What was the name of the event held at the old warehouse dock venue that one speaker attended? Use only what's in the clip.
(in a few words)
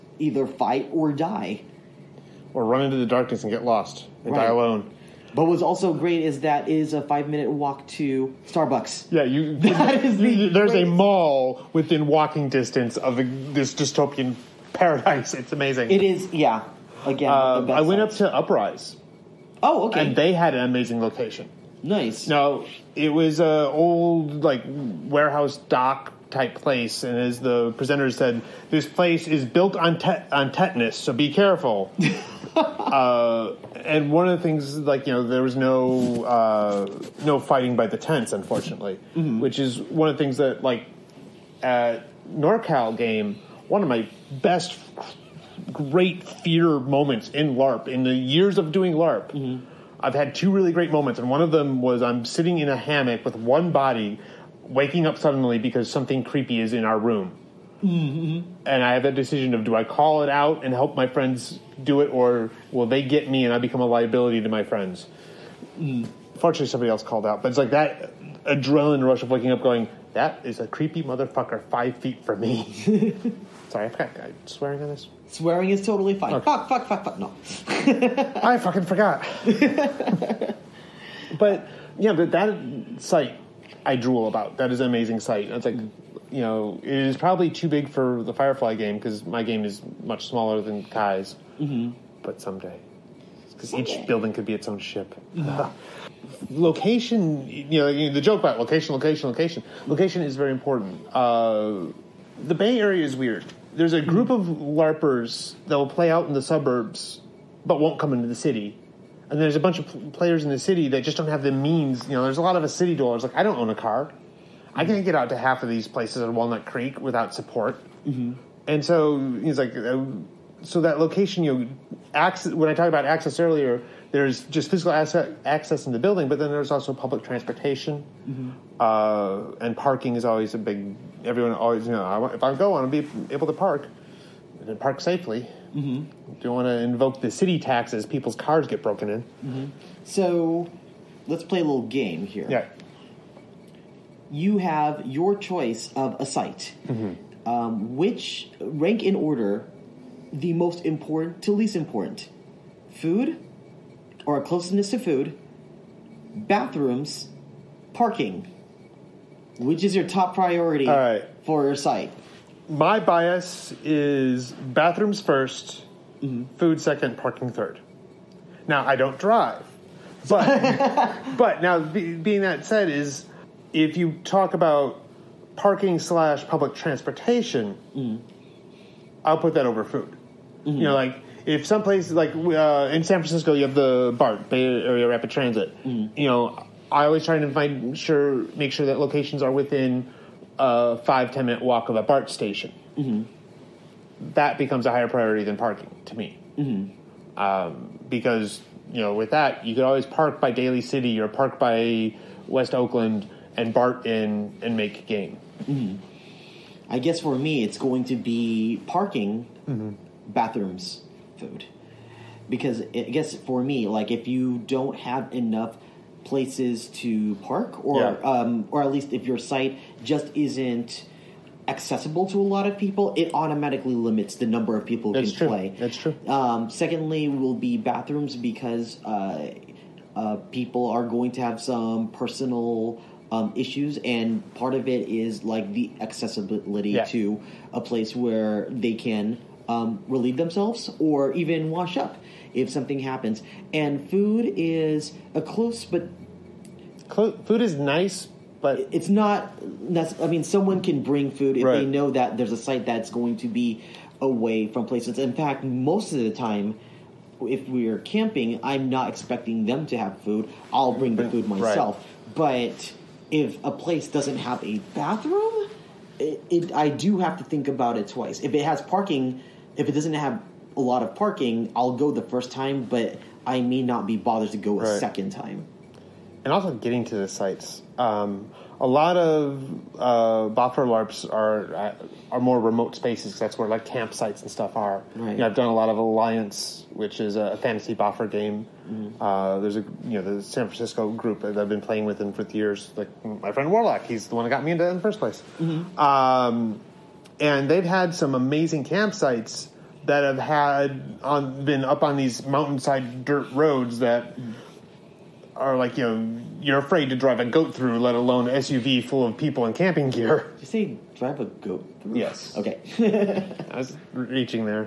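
Uprise.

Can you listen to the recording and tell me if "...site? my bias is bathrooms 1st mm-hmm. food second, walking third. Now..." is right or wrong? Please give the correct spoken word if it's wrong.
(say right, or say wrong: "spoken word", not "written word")
wrong: "parking", not "walking".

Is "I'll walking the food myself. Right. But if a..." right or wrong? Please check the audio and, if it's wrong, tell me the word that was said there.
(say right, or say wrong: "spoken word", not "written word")
wrong: "bring", not "walking".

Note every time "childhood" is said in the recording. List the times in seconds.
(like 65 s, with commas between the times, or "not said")
not said.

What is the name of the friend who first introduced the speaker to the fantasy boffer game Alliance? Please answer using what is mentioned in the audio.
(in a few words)
Warlock.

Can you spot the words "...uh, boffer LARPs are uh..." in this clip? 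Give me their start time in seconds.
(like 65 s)
279 s.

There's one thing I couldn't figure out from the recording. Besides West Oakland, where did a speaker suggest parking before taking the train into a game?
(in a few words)
Daly City.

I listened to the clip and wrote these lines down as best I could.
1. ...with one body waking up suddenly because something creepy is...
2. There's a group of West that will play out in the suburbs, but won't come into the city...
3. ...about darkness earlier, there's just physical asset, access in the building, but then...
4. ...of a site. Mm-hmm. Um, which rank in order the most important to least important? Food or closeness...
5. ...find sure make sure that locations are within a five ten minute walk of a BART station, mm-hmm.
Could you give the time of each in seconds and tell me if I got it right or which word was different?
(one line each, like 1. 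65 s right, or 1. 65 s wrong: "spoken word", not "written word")
1. 53 s right
2. 103 s wrong: "LARPers", not "West"
3. 122 s wrong: "access", not "darkness"
4. 145 s right
5. 187 s right.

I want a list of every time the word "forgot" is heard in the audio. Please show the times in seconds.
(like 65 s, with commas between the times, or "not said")
73 s, 78 s.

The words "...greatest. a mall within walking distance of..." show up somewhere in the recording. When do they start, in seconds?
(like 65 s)
10 s.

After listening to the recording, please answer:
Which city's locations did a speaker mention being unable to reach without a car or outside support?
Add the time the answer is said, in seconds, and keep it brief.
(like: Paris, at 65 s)
Walnut Creek, at 116 s.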